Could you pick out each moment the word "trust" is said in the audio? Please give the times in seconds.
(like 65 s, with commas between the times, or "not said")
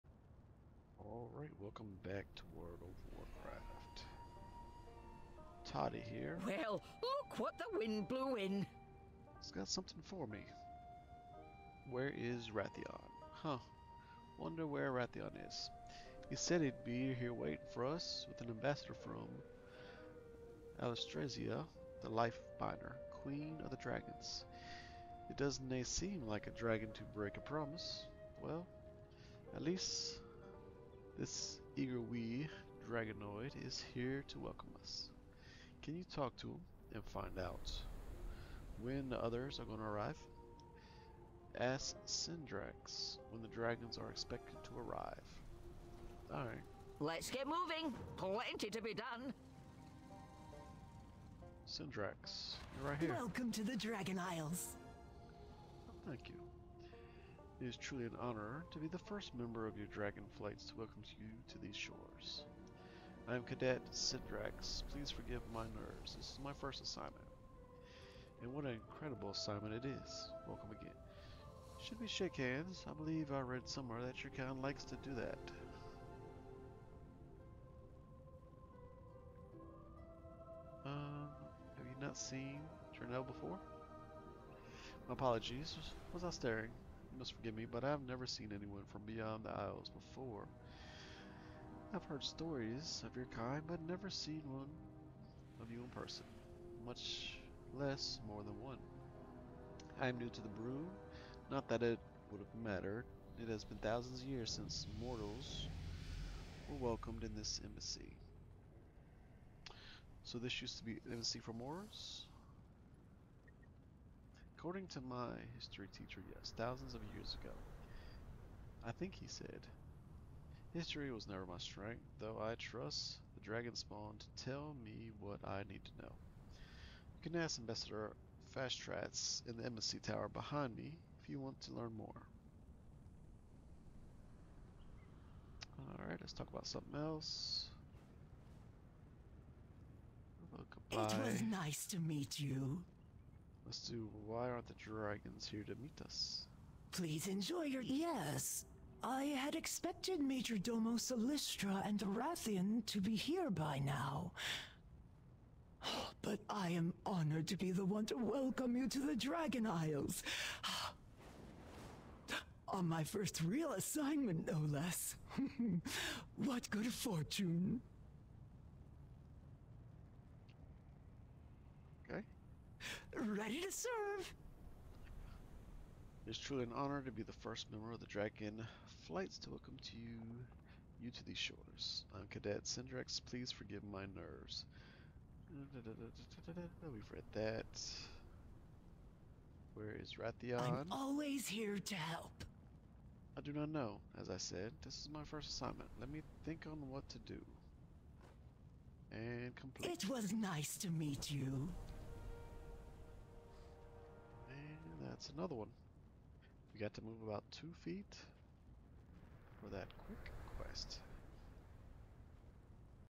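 122 s.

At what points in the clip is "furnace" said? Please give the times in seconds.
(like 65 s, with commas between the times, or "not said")
not said.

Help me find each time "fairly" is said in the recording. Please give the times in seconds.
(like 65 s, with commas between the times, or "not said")
not said.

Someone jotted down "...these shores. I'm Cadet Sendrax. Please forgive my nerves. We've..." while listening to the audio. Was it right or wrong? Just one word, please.
right.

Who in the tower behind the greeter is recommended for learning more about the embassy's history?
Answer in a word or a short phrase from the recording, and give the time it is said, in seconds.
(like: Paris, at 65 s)
Ambassador Fastratz, at 127 s.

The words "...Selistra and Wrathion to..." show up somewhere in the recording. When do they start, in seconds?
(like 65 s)
150 s.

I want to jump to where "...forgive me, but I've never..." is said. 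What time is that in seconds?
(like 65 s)
87 s.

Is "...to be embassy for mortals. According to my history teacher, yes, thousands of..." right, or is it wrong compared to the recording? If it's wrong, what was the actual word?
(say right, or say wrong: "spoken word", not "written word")
right.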